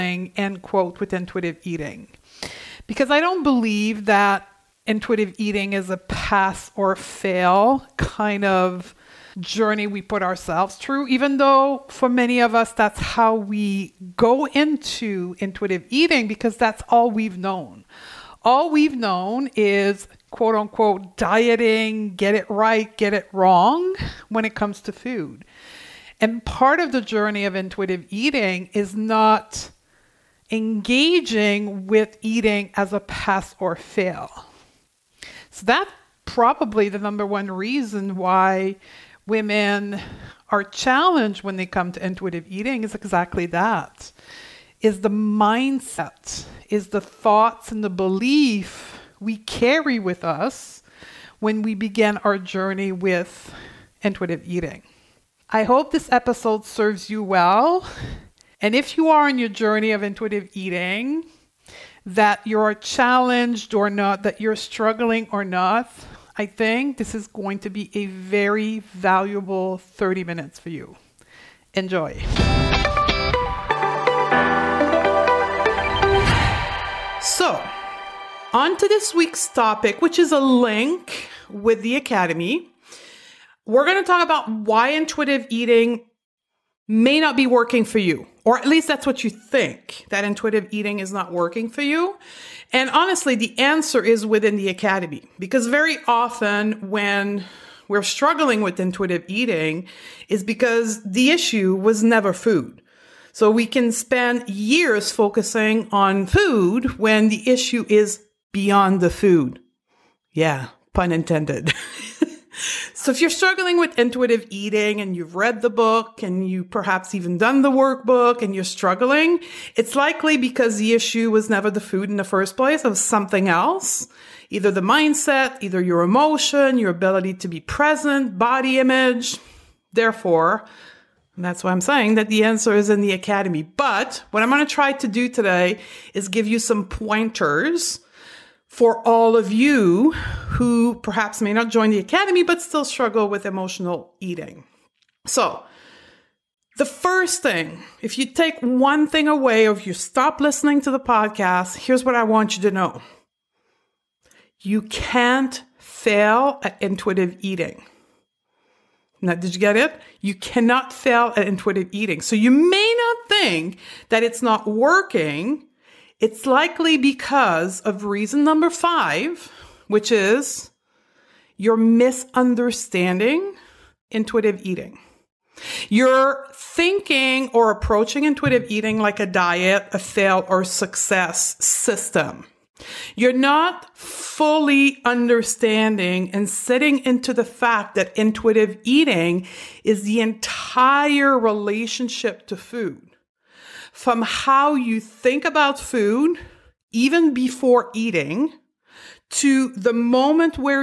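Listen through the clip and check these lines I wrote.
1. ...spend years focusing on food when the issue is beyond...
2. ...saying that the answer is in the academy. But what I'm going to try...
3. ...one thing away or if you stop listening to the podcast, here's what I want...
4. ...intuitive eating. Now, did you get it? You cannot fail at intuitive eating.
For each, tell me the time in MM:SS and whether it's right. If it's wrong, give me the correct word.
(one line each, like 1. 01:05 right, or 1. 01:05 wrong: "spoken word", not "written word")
1. 01:43 right
2. 02:11 right
3. 02:28 right
4. 02:36 right.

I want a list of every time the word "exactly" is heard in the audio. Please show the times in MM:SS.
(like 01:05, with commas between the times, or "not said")
00:42.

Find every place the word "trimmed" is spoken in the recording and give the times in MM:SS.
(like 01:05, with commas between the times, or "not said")
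not said.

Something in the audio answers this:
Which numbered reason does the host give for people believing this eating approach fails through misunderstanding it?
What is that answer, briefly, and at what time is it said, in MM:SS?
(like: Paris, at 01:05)
5, at 02:48.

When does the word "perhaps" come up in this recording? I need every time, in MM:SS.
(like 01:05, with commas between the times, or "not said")
01:56, 02:20.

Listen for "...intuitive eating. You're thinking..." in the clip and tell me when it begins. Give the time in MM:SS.
02:54.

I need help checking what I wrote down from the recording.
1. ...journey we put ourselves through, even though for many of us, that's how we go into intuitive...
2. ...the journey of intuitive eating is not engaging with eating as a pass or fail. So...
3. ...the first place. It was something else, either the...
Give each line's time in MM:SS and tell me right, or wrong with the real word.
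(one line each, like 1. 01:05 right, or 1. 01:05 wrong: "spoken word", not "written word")
1. 00:09 right
2. 00:26 right
3. 02:02 right.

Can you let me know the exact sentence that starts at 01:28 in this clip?
Or at least that's what you think, that intuitive eating is not working for you.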